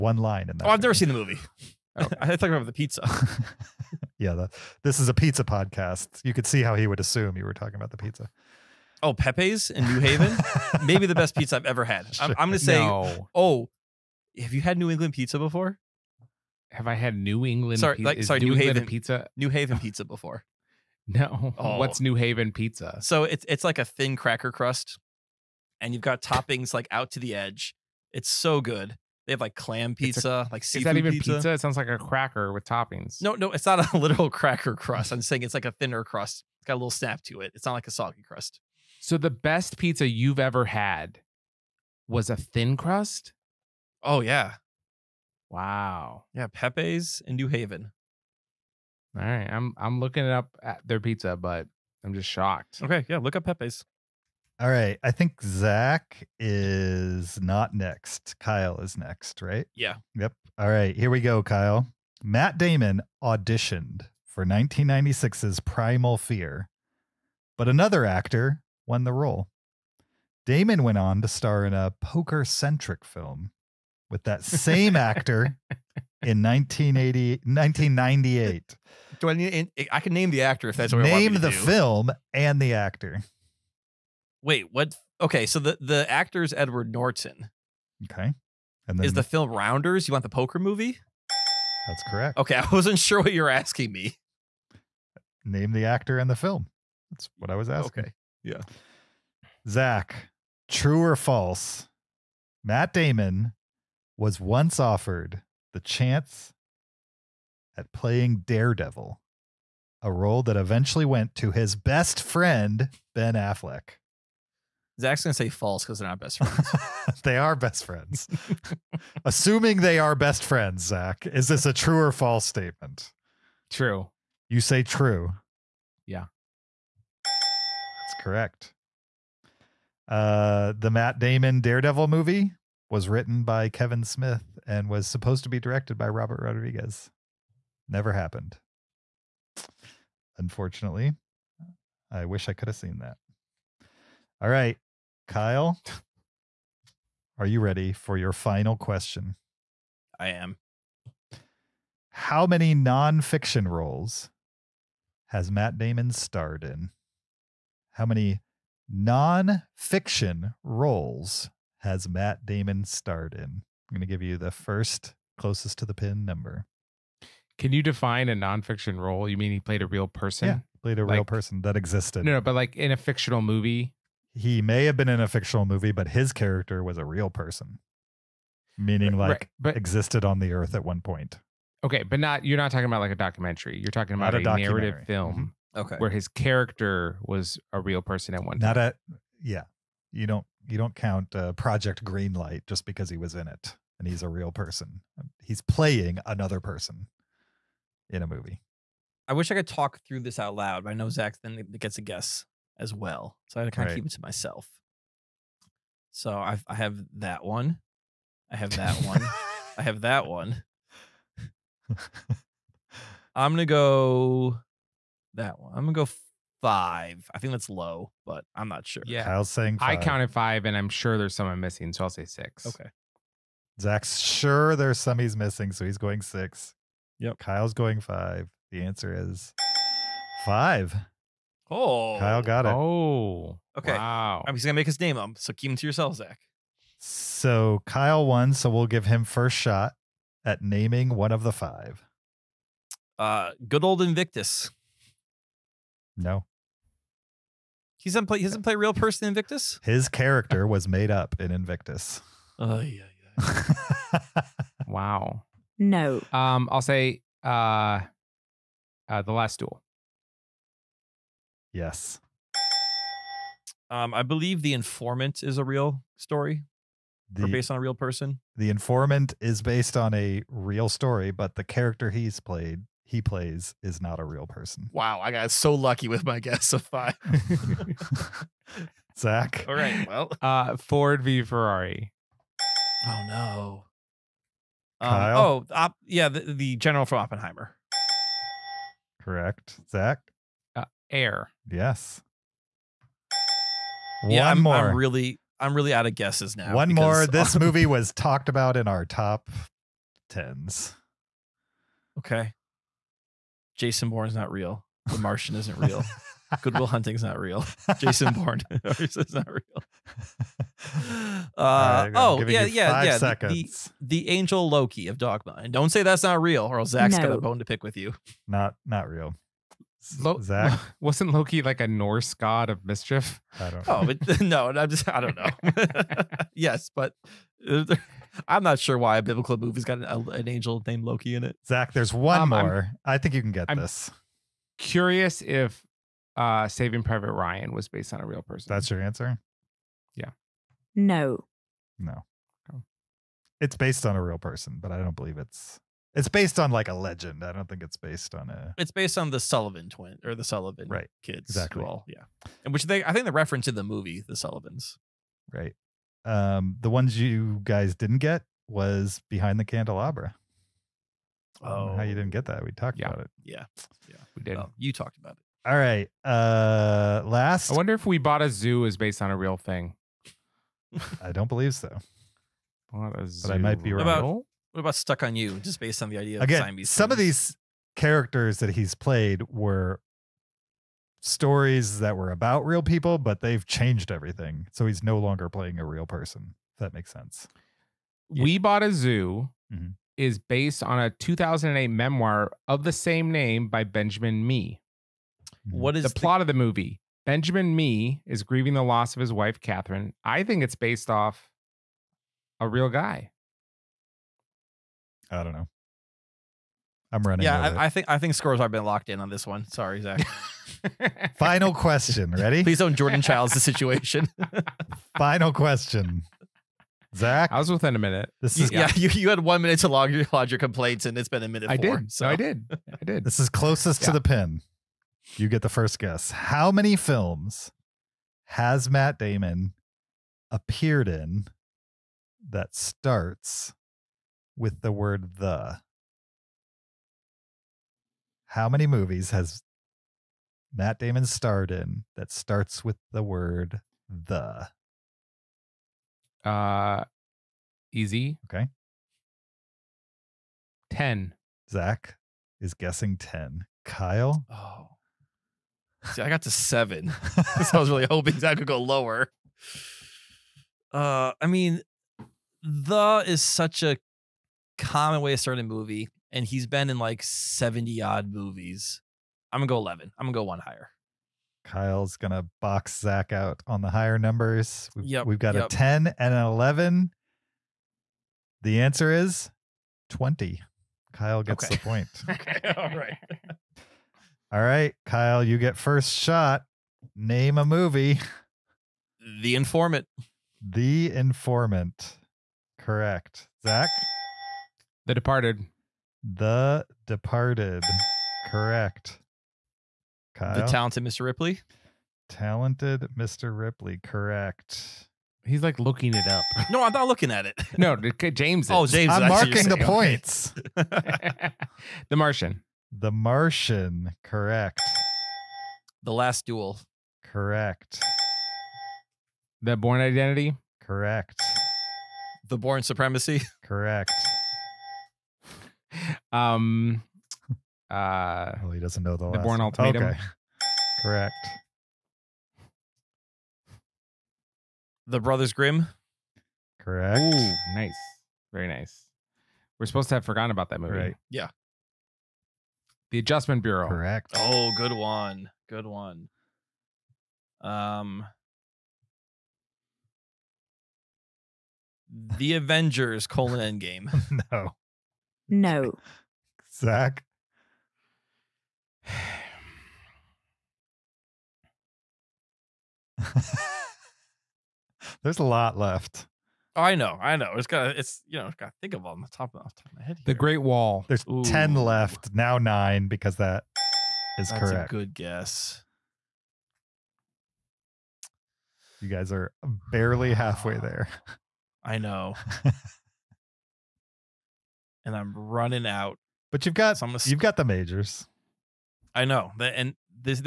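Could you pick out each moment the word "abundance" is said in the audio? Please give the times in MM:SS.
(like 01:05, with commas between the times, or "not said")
not said.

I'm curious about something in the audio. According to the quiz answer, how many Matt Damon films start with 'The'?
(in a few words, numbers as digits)
20.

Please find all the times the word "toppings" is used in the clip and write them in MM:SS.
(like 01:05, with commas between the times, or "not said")
00:26, 00:32.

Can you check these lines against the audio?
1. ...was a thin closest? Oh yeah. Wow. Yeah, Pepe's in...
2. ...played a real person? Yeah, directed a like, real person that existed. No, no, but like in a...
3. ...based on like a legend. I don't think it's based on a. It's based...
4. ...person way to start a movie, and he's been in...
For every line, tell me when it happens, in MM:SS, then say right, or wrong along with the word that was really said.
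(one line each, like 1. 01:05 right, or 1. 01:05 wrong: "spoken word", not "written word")
1. 00:42 wrong: "crust", not "closest"
2. 02:49 wrong: "played", not "directed"
3. 05:46 right
4. 07:44 wrong: "common", not "person".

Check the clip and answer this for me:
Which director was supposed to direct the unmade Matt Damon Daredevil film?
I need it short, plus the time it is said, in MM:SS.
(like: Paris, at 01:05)
Robert Rodriguez, at 02:16.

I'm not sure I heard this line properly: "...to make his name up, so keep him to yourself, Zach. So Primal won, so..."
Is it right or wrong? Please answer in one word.
wrong.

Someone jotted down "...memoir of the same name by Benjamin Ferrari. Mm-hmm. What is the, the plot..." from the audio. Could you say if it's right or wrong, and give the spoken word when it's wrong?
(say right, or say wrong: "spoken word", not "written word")
wrong: "Mee", not "Ferrari".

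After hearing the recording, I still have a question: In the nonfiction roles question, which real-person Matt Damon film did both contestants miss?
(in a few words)
Behind the Candelabra.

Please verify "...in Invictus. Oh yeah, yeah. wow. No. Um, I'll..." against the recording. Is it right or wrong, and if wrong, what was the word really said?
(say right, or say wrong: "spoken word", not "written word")
right.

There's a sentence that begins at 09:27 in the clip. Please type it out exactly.
It's got, it's you know, it's got to think of on the top of, off the top of my head.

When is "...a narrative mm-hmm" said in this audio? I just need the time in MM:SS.
03:04.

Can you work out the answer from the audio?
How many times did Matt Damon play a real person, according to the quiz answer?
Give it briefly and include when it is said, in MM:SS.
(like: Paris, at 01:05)
5, at 03:48.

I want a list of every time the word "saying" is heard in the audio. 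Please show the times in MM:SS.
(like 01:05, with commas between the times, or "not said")
00:35, 03:39.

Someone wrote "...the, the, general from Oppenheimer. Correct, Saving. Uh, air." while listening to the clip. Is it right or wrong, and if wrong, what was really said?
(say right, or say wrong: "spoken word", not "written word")
wrong: "Zach", not "Saving".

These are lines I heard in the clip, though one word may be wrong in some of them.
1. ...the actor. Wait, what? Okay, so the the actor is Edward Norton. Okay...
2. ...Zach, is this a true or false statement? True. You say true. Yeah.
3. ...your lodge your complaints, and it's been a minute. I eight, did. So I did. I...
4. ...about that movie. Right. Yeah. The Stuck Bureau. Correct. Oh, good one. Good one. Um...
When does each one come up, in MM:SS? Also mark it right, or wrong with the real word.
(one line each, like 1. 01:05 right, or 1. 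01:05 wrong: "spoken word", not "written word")
1. 01:22 right
2. 02:00 right
3. 07:00 wrong: "four", not "eight"
4. 09:00 wrong: "Adjustment", not "Stuck".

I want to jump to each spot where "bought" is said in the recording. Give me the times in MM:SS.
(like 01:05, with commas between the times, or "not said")
06:08, 06:12, 06:28.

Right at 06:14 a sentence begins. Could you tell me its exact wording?
About what about Stuck on You?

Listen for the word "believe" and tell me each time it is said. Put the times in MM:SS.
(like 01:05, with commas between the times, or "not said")
04:24, 05:45, 06:11.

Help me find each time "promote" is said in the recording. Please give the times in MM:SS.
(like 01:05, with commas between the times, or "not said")
not said.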